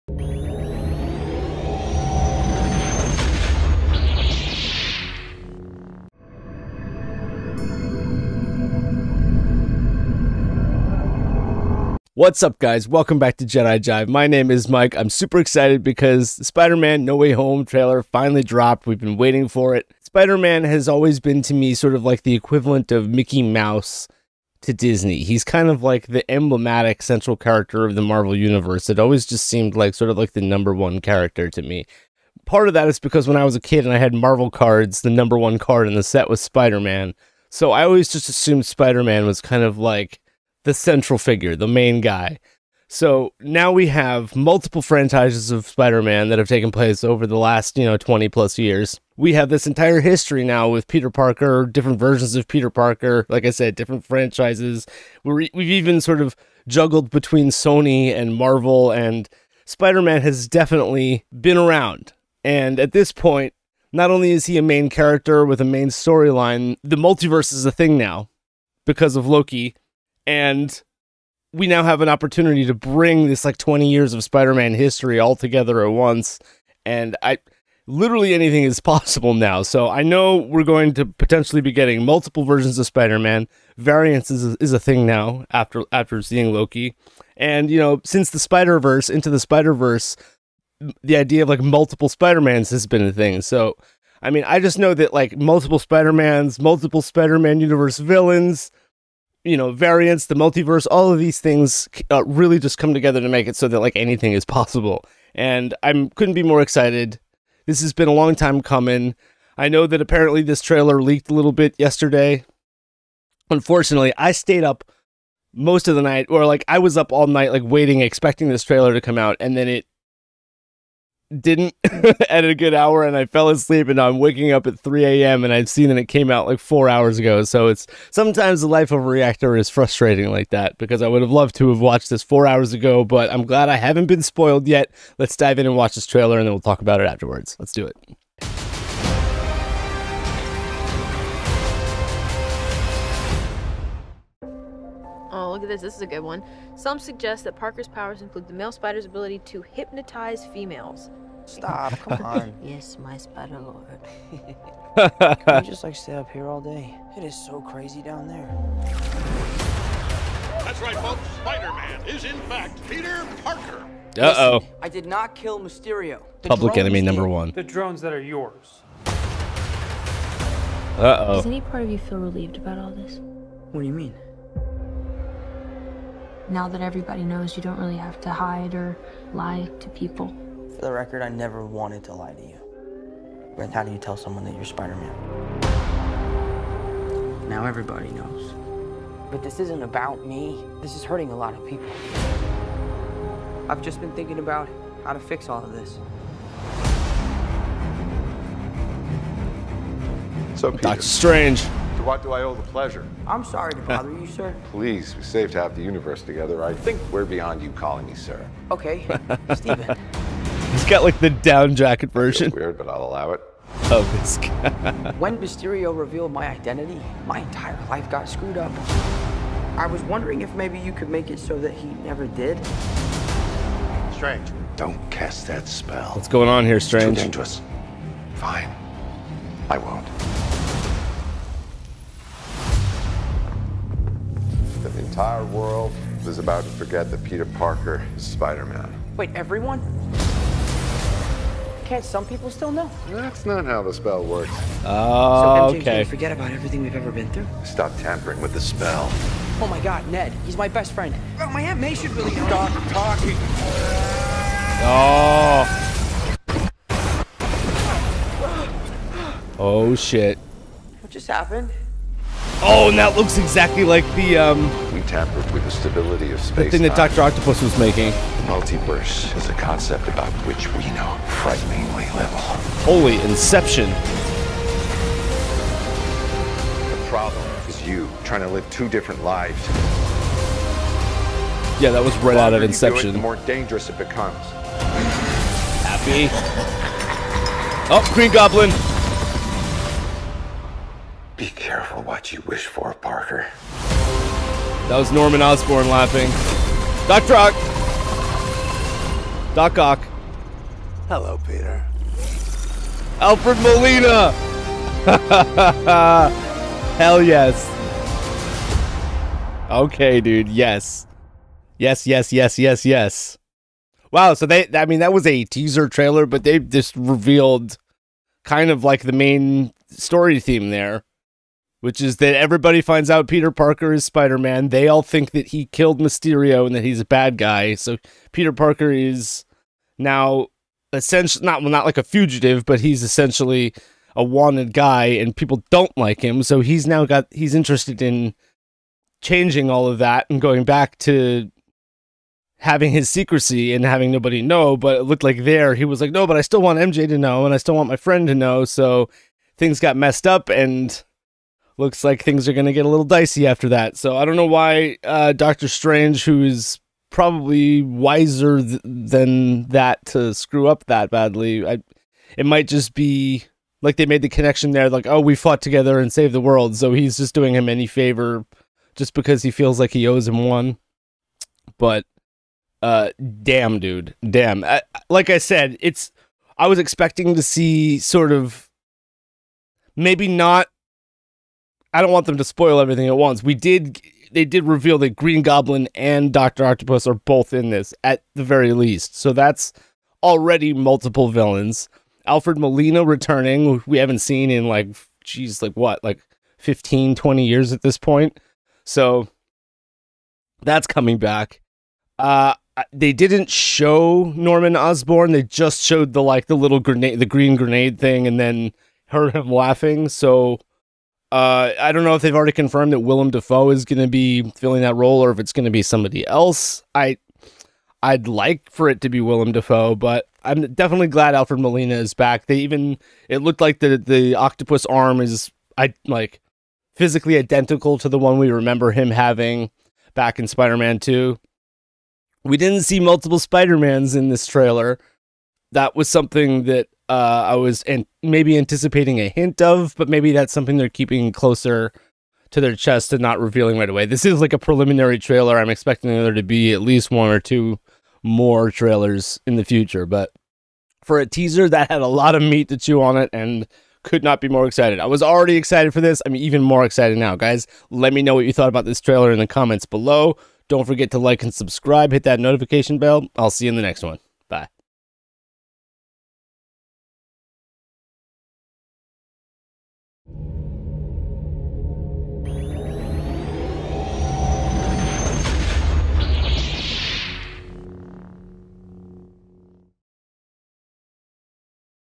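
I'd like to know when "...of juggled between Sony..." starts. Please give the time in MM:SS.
00:56.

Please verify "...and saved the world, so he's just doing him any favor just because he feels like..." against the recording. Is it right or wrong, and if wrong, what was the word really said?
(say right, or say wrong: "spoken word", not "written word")
right.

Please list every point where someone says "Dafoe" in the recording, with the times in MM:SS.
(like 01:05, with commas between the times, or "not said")
06:53, 06:59.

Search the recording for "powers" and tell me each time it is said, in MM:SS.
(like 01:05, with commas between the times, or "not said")
02:27.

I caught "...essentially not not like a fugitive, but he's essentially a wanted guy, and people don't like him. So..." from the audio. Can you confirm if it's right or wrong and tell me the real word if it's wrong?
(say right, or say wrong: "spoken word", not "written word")
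right.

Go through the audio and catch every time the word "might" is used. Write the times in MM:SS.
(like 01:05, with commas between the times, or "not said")
06:02.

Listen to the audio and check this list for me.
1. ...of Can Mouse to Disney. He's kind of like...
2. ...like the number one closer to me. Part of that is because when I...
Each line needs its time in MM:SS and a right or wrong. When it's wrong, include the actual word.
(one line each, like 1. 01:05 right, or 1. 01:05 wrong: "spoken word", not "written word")
1. 00:22 wrong: "Mickey", not "Can"
2. 00:30 wrong: "character", not "closer".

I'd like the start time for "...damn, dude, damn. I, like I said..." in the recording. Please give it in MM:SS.
06:13.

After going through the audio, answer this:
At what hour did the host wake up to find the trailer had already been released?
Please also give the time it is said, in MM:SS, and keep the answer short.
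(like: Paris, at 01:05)
3 a.m., at 02:04.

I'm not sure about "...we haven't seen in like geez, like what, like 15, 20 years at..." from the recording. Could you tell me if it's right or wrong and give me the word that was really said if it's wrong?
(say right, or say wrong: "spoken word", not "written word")
right.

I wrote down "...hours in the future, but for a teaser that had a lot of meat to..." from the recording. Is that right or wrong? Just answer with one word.
wrong.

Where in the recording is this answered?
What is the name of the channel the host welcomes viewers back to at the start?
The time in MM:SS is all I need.
00:13.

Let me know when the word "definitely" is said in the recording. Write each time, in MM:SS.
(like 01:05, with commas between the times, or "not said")
01:00, 07:00.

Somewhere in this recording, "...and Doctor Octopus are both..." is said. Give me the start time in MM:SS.
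06:25.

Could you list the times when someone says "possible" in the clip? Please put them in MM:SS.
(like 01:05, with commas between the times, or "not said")
01:18, 01:44.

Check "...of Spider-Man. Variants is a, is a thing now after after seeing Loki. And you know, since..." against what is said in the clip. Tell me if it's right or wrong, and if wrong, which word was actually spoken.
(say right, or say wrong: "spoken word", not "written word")
right.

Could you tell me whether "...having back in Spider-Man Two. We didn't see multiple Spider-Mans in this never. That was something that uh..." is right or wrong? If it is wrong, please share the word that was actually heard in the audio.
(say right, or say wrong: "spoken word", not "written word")
wrong: "trailer", not "never".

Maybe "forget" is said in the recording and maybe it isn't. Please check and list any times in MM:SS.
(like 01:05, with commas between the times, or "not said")
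03:56, 04:06, 07:40.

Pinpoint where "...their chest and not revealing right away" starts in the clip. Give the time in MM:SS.
07:22.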